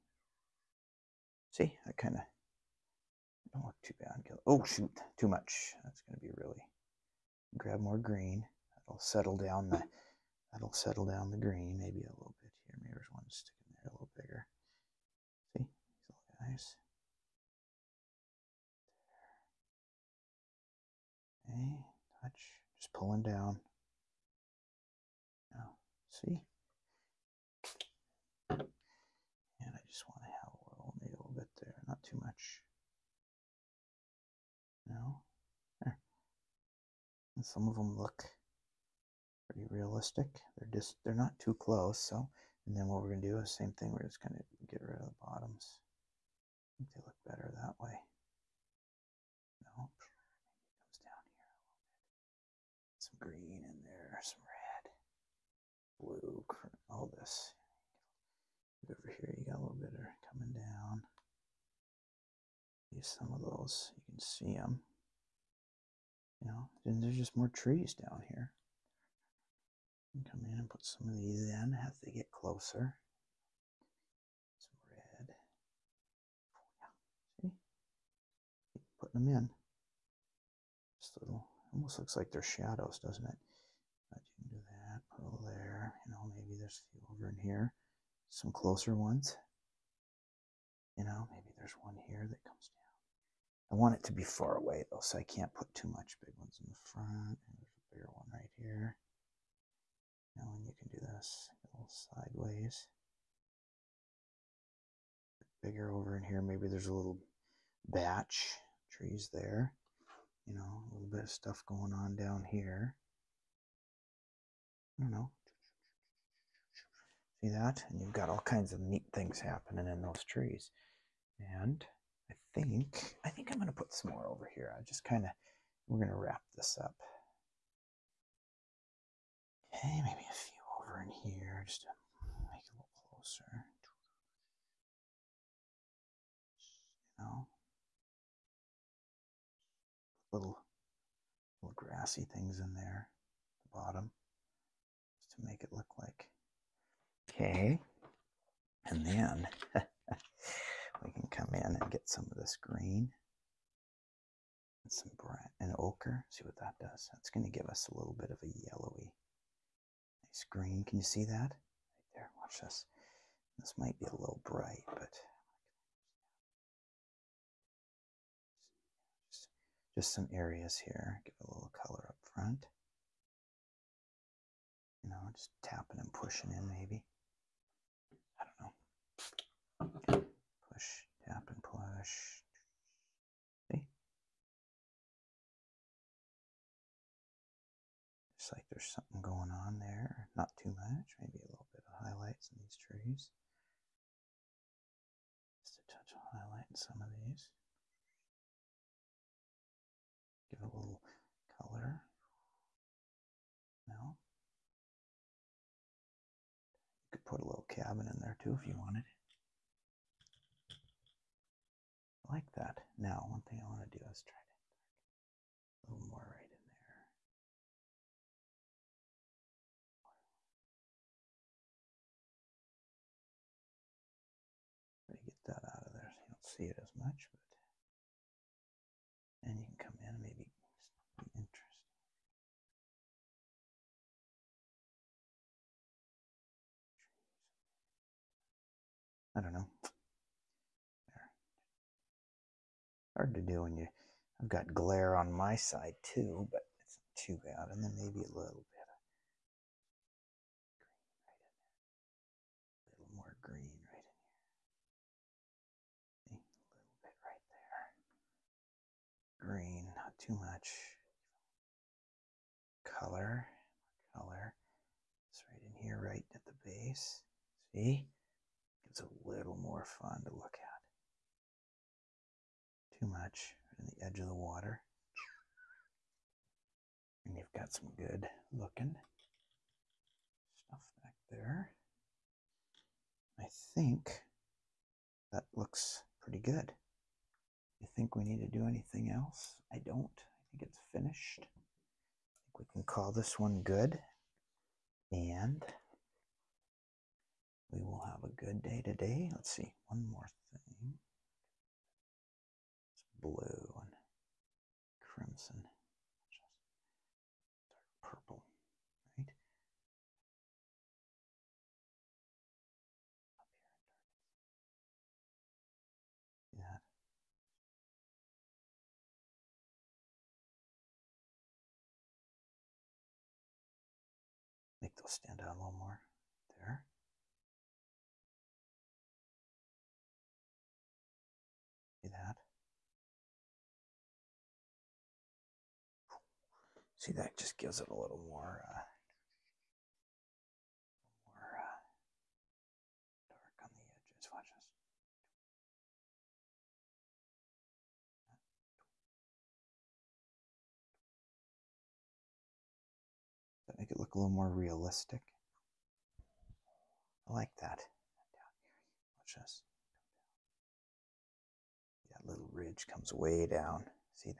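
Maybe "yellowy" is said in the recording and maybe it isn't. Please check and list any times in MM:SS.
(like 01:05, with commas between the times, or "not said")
02:38.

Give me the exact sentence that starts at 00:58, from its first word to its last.
Over here, you got a little bit some of those.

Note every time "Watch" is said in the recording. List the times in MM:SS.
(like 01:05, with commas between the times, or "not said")
02:42, 05:44, 05:59.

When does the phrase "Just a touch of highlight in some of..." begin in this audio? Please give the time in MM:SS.
03:15.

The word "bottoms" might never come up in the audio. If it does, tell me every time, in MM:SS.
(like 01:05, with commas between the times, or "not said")
00:45, 02:23.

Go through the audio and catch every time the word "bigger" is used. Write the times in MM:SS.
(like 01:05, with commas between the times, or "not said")
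00:14, 01:37, 01:45.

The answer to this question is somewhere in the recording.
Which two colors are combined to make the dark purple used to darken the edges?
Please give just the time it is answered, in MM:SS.
05:03.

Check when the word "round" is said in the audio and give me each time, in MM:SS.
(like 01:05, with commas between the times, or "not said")
not said.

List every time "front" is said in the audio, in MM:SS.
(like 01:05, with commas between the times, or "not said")
01:36, 02:52.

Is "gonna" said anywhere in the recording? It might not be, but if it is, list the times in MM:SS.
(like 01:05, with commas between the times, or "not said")
00:06.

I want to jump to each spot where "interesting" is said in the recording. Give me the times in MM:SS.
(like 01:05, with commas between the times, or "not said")
03:51.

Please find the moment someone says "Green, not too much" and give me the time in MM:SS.
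04:19.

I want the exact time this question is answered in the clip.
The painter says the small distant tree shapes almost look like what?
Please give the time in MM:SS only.
01:22.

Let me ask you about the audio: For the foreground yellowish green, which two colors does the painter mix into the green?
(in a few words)
brown and ochre.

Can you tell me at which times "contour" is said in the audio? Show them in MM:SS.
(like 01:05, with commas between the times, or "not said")
not said.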